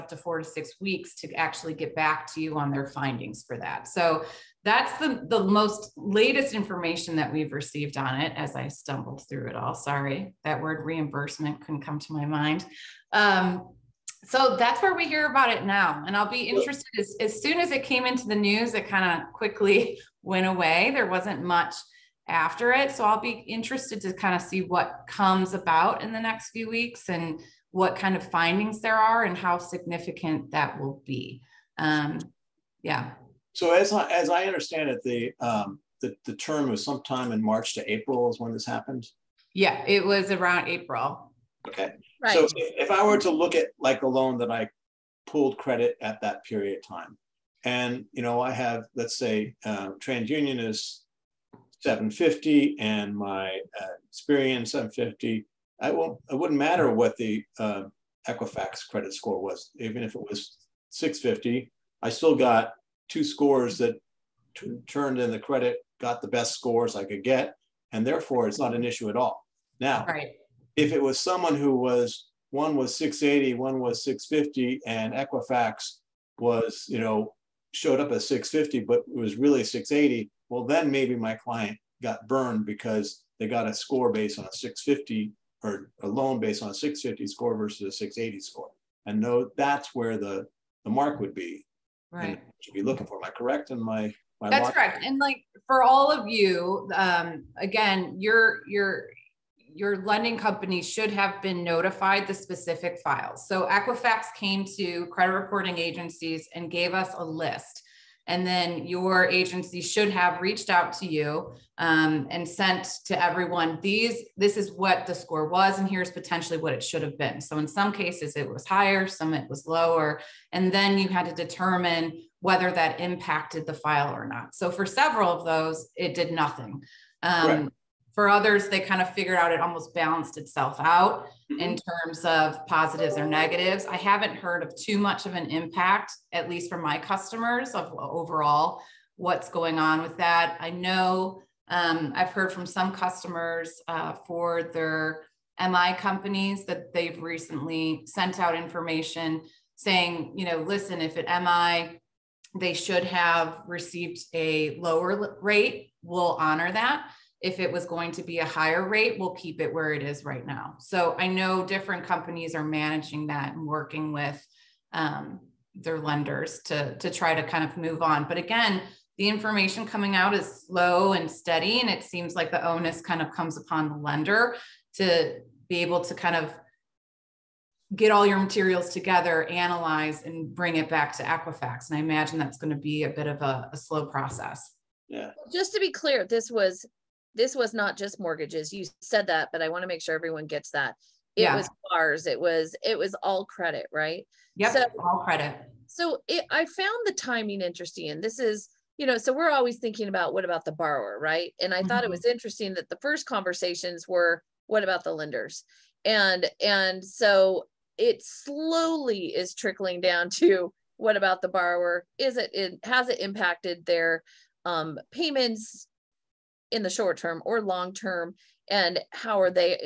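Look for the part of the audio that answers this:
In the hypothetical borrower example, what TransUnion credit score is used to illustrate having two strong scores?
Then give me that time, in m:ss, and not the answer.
0:49.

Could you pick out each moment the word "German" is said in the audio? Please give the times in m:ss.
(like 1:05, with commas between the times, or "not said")
not said.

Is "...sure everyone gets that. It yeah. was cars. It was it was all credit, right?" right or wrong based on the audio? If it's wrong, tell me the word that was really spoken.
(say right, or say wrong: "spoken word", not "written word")
right.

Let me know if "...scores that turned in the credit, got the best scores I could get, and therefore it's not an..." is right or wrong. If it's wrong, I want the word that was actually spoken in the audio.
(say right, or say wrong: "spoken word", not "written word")
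right.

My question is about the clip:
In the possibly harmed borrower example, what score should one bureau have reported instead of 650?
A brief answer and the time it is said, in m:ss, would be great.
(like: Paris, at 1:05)
680, at 1:18.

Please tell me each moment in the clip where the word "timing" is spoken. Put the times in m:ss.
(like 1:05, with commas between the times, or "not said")
3:17.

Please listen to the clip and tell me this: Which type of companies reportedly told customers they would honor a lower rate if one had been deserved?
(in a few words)
MI companies.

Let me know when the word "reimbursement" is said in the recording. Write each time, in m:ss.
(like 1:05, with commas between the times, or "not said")
0:10.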